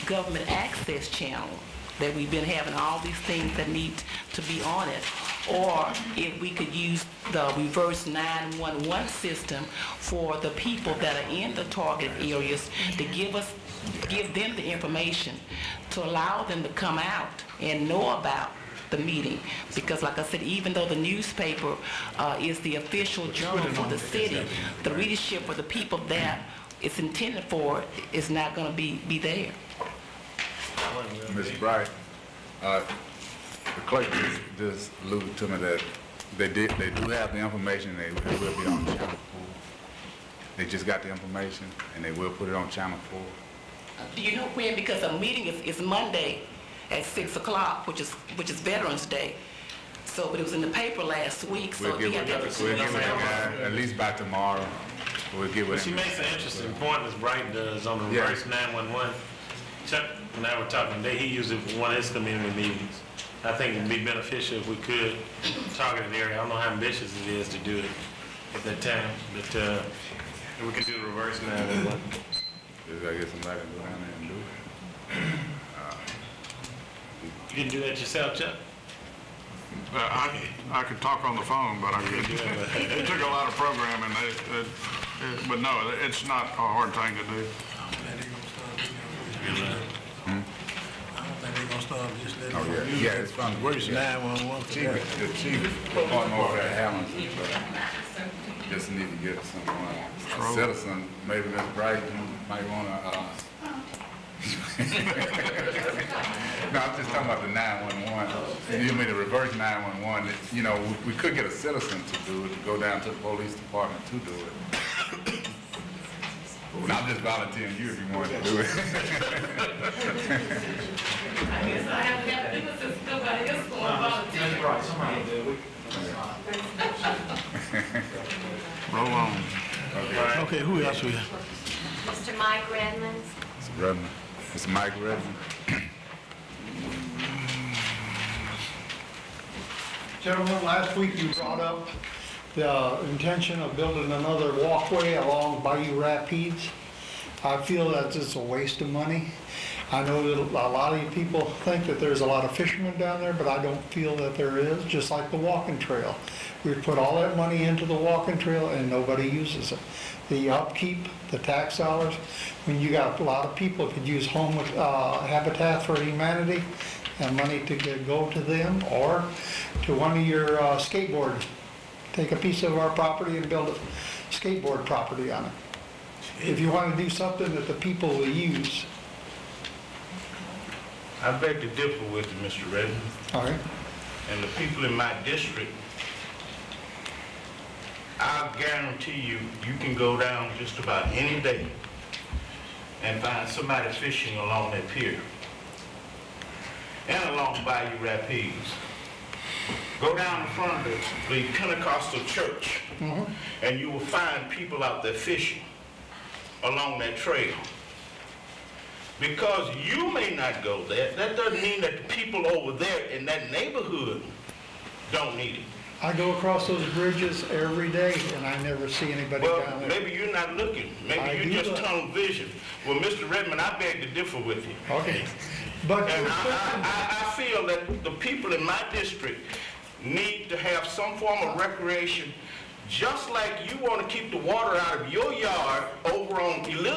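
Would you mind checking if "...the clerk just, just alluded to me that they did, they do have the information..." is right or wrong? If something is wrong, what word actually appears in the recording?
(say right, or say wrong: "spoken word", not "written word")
right.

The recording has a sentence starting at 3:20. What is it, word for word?
Go down in front of the, Pentecostal church, mm-hmm.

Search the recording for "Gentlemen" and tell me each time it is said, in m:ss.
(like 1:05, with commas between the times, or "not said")
2:20.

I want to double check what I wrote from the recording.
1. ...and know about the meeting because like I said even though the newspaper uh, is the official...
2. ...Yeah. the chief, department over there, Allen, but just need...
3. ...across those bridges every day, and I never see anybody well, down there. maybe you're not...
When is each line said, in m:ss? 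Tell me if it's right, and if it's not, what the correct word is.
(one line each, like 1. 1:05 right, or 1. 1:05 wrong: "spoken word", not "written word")
1. 0:17 right
2. 1:34 right
3. 3:36 right.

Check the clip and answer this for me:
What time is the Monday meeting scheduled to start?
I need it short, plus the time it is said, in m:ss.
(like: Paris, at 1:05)
6 o'clock, at 0:47.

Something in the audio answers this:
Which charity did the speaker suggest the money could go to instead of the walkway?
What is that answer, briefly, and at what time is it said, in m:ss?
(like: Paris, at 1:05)
Habitat for Humanity, at 2:45.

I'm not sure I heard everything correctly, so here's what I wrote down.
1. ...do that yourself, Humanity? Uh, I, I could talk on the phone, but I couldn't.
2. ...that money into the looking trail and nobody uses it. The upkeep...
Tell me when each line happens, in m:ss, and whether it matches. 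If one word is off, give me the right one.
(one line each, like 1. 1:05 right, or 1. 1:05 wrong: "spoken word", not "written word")
1. 1:17 wrong: "Chuck", not "Humanity"
2. 2:37 wrong: "walking", not "looking".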